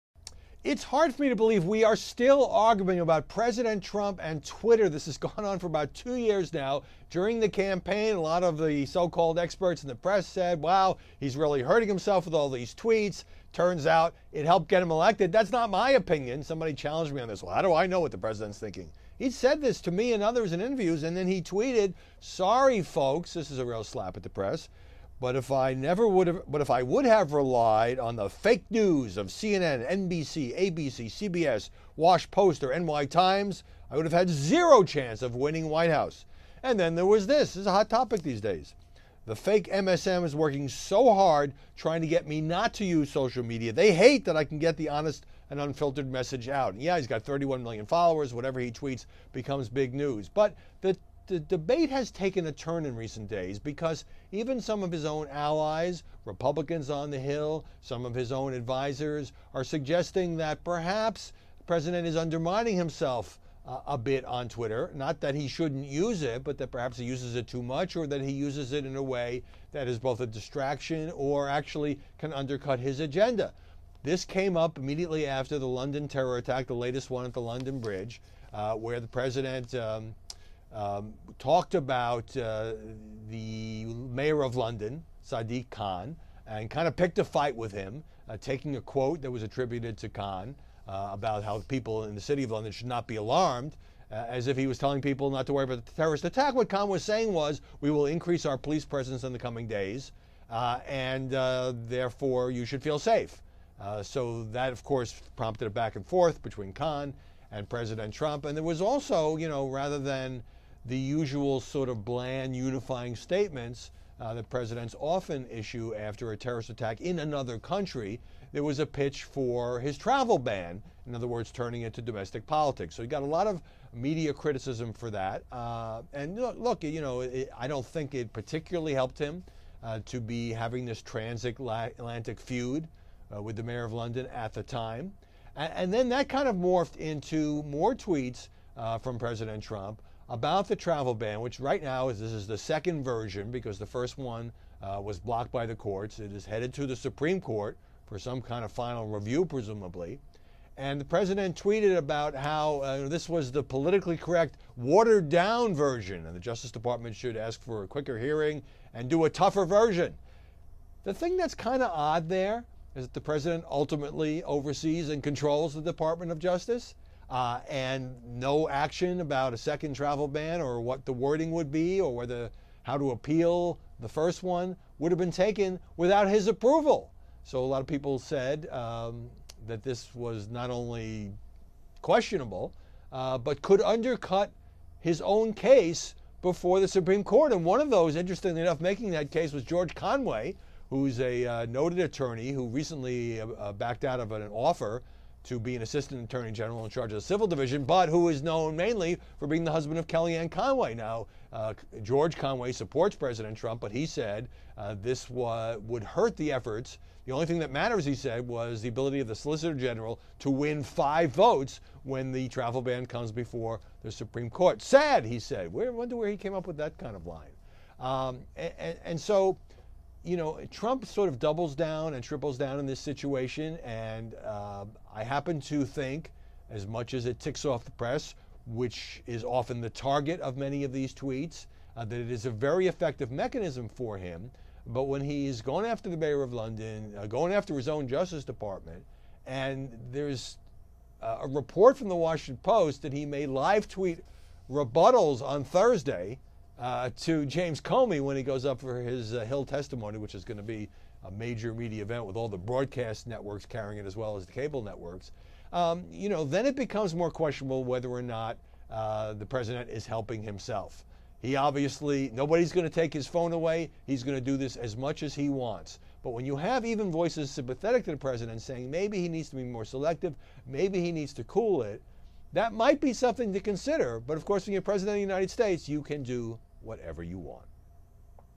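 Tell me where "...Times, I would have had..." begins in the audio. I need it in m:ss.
0:33.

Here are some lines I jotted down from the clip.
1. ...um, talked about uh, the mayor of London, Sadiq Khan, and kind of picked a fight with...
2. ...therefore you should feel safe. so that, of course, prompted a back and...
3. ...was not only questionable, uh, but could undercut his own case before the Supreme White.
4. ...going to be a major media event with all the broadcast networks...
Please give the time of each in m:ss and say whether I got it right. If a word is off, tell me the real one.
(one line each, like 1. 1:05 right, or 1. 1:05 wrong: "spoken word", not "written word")
1. 1:20 right
2. 1:41 right
3. 3:00 wrong: "Court", not "White"
4. 4:10 right.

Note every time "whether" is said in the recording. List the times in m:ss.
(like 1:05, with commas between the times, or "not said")
2:52, 4:17.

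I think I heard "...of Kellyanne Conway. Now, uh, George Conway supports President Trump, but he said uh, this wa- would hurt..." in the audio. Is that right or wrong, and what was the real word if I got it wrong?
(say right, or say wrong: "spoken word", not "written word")
right.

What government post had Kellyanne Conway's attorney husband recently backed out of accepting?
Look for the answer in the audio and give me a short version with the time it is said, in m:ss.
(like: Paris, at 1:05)
Assistant attorney general, at 3:15.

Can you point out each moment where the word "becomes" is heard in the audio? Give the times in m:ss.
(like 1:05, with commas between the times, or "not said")
0:49, 4:16.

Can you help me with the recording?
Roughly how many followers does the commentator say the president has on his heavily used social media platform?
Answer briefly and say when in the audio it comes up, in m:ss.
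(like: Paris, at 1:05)
31 million, at 0:47.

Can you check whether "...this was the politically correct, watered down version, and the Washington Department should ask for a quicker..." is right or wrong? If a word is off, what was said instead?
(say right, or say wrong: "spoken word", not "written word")
wrong: "Justice", not "Washington".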